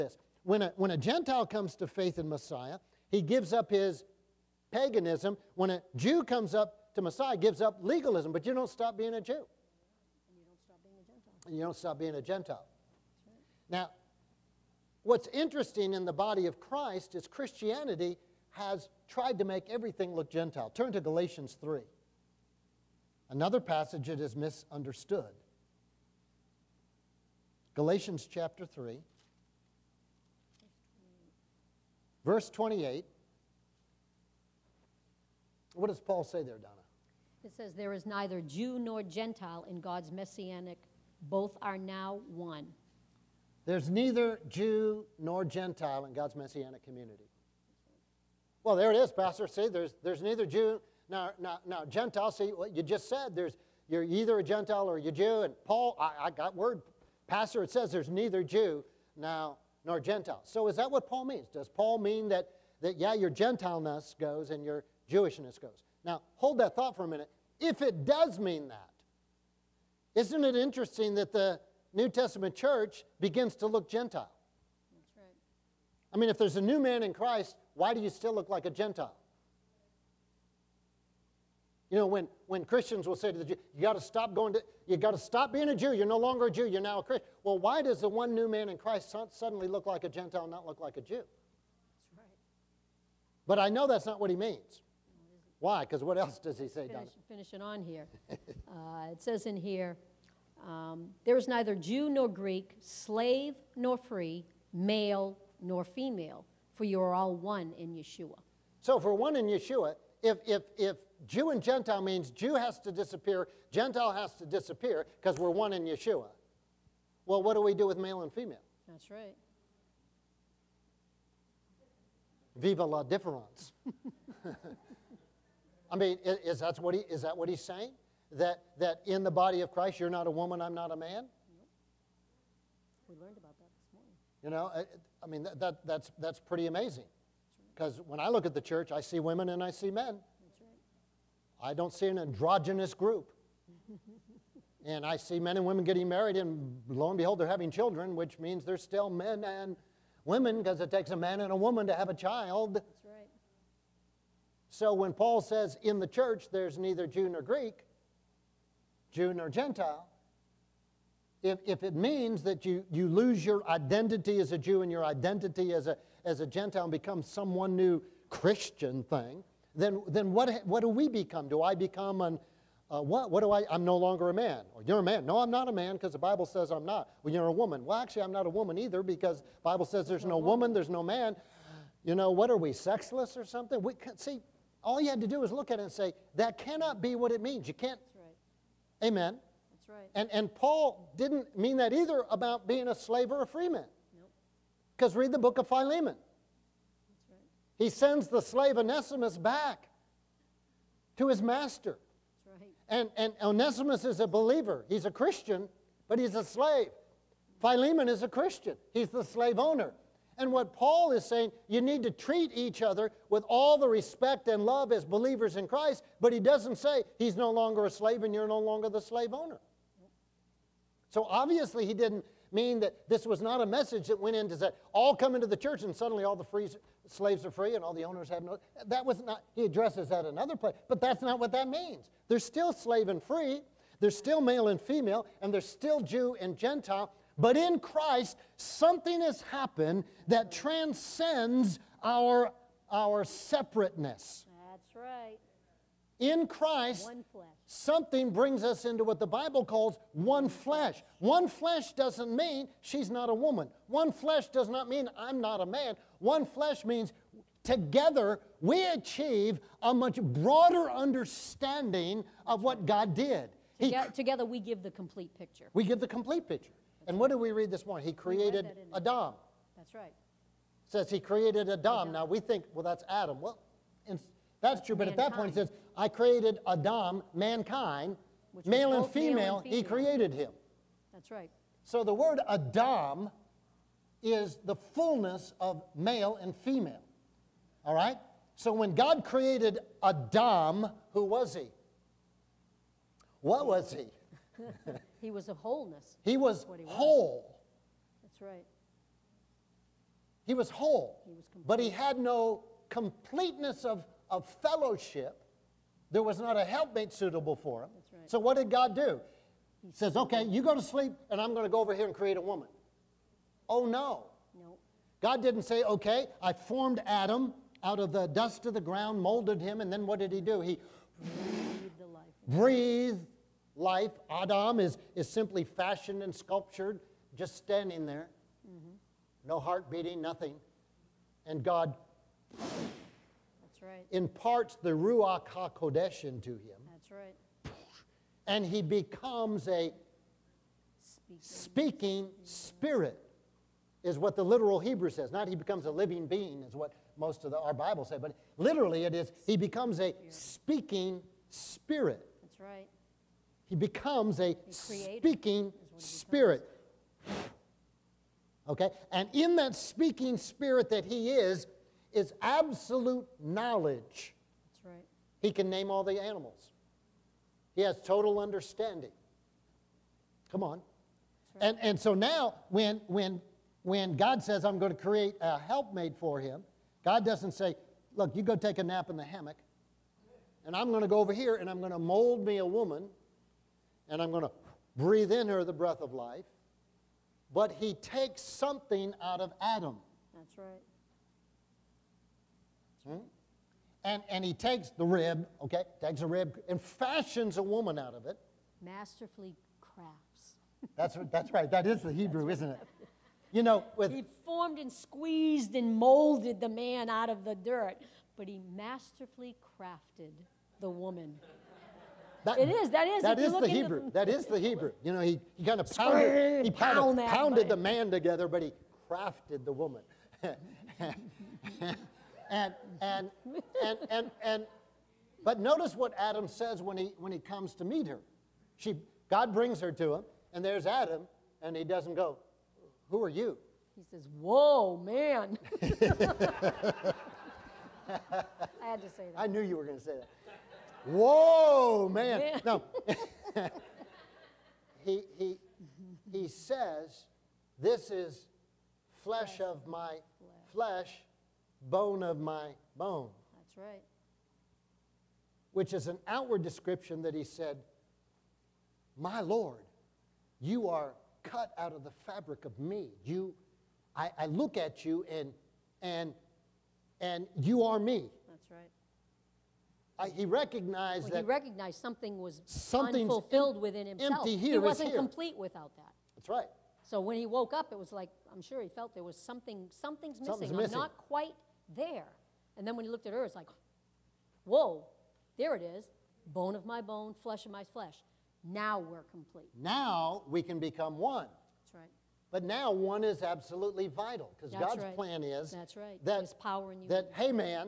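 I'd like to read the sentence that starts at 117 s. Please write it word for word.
Well, what do we do with male and female?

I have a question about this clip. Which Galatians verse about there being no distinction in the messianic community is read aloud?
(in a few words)
Verse 28.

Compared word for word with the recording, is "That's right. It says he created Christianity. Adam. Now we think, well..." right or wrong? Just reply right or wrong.
wrong.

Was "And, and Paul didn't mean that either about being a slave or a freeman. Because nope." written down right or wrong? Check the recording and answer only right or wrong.
right.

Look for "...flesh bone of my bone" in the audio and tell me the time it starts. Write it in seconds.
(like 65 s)
450 s.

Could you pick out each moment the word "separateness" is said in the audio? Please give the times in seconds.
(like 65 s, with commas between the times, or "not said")
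243 s.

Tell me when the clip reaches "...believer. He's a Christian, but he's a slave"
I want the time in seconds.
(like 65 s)
204 s.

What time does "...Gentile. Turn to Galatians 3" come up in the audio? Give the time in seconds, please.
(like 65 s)
20 s.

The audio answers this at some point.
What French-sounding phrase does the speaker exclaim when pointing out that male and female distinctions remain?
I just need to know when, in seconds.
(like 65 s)
122 s.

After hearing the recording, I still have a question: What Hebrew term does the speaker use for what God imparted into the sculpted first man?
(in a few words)
Ruach HaKodesh.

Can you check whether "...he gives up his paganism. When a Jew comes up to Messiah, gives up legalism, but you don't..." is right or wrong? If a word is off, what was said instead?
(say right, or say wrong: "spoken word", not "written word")
right.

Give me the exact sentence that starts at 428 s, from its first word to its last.
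She, God brings her to him, and there's Adam, and he doesn't go, Who are you?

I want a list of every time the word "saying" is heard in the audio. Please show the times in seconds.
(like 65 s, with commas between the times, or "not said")
127 s, 211 s.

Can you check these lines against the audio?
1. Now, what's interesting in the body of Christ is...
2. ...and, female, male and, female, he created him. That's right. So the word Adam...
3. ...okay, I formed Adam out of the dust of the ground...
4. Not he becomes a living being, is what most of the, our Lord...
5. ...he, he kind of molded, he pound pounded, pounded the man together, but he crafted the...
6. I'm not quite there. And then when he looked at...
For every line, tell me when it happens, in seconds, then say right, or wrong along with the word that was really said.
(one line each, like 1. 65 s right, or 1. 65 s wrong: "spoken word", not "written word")
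1. 13 s right
2. 279 s right
3. 315 s right
4. 345 s wrong: "Bible", not "Lord"
5. 415 s wrong: "pounded", not "molded"
6. 480 s right.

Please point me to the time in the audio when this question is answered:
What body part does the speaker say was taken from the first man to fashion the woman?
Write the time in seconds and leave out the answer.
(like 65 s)
394 s.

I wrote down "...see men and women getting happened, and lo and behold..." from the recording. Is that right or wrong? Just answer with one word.
wrong.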